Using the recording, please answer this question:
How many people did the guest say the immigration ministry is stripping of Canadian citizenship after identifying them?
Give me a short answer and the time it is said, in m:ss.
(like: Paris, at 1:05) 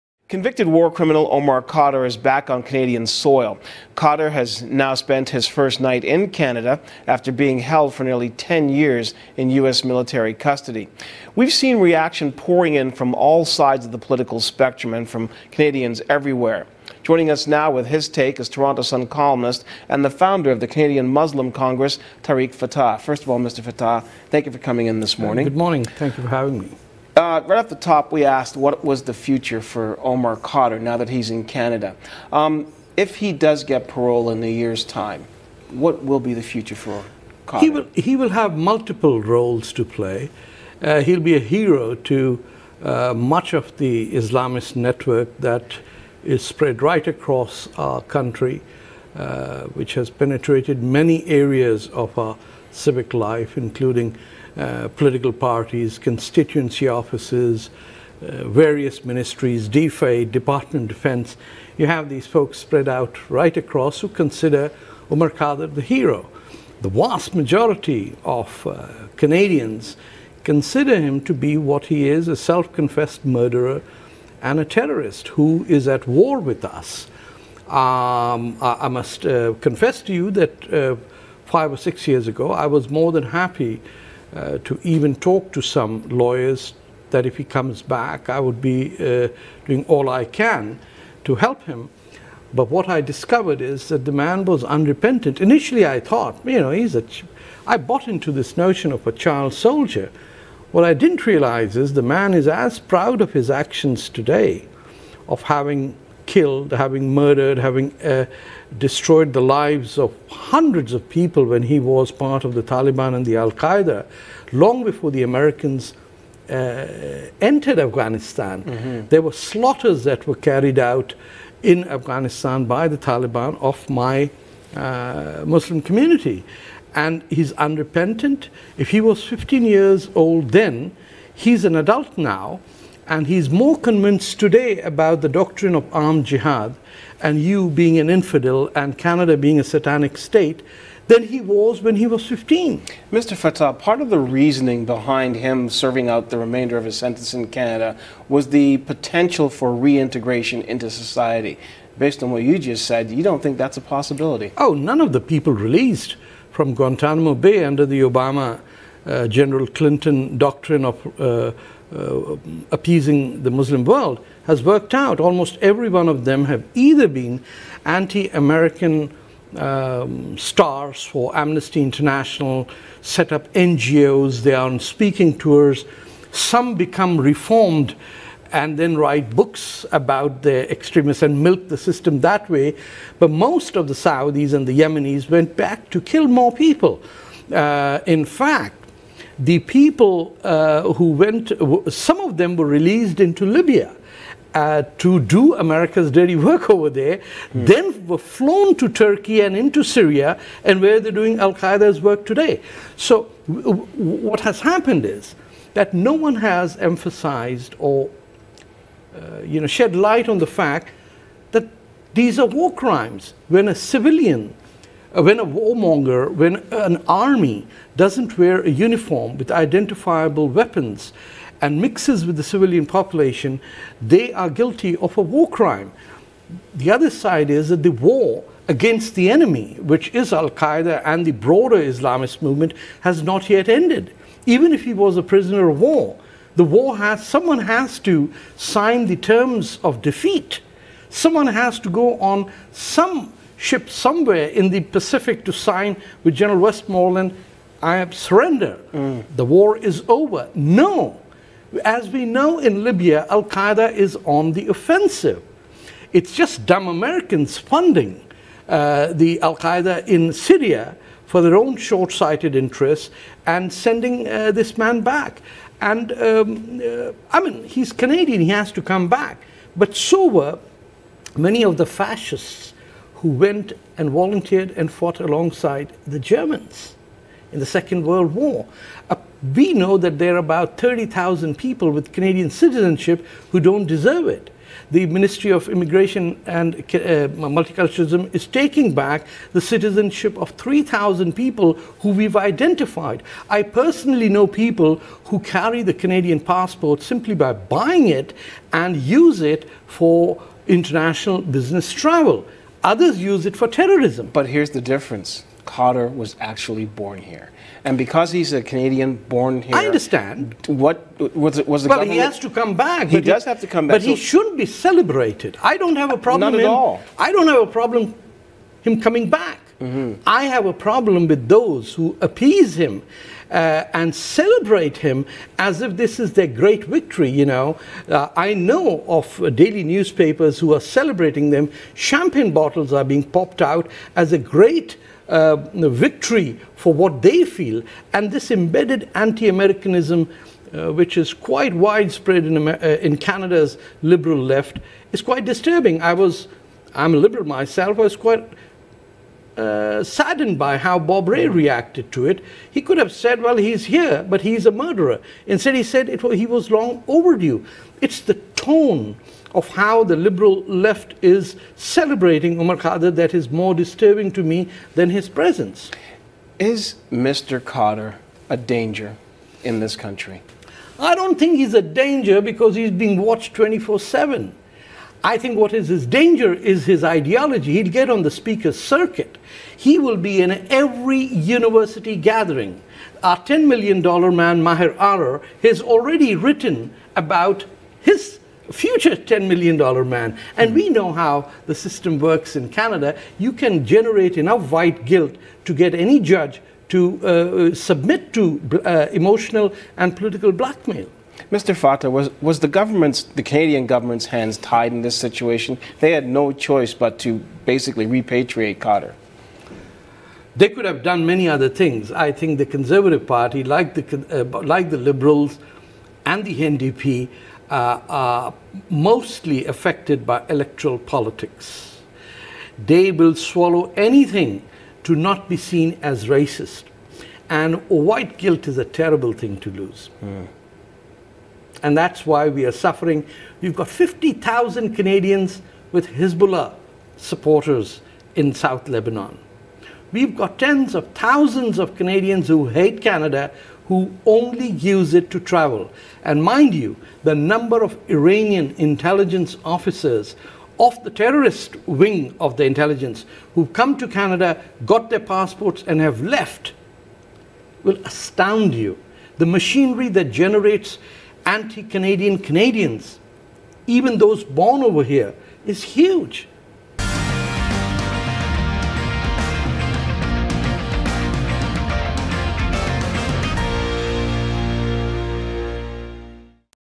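3,000, at 4:50.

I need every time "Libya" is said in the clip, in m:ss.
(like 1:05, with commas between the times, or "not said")
3:13, 4:12.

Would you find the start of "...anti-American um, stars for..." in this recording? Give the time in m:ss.
2:47.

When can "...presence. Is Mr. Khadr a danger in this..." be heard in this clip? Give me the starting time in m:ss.
6:05.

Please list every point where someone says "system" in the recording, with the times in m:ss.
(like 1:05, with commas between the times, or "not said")
3:01, 6:31.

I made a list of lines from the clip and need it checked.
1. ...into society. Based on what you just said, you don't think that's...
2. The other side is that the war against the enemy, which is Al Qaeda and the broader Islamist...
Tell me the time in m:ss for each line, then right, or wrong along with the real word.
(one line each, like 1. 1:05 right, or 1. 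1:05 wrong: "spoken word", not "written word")
1. 2:30 right
2. 3:46 right.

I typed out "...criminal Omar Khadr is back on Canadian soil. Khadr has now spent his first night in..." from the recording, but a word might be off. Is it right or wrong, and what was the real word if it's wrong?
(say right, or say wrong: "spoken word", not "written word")
right.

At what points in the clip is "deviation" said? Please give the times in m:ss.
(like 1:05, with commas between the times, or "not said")
not said.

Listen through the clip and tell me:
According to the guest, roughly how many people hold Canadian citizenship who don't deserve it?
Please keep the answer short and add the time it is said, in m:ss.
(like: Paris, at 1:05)
30,000, at 4:40.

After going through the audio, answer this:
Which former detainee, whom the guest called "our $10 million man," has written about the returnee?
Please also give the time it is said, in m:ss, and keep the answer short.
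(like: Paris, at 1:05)
Maher Arar, at 6:24.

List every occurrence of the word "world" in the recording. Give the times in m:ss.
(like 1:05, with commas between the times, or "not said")
2:43, 4:38.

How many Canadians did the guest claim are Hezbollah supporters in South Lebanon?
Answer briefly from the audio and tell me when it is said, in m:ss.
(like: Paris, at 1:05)
50,000, at 7:13.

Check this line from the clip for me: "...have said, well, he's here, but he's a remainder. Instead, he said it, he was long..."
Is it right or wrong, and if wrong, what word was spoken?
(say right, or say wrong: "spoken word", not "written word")
wrong: "murderer", not "remainder".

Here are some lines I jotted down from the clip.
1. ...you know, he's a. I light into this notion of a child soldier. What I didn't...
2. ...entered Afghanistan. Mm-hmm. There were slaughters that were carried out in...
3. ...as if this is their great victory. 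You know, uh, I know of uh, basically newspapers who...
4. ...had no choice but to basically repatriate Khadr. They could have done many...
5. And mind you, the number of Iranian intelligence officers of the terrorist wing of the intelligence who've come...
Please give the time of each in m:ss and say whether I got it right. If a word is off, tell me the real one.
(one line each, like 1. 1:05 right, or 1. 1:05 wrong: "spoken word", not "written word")
1. 1:36 wrong: "bought", not "light"
2. 1:57 right
3. 5:25 wrong: "daily", not "basically"
4. 6:46 right
5. 7:26 right.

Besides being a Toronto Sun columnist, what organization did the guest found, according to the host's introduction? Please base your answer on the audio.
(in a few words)
Canadian Muslim Congress.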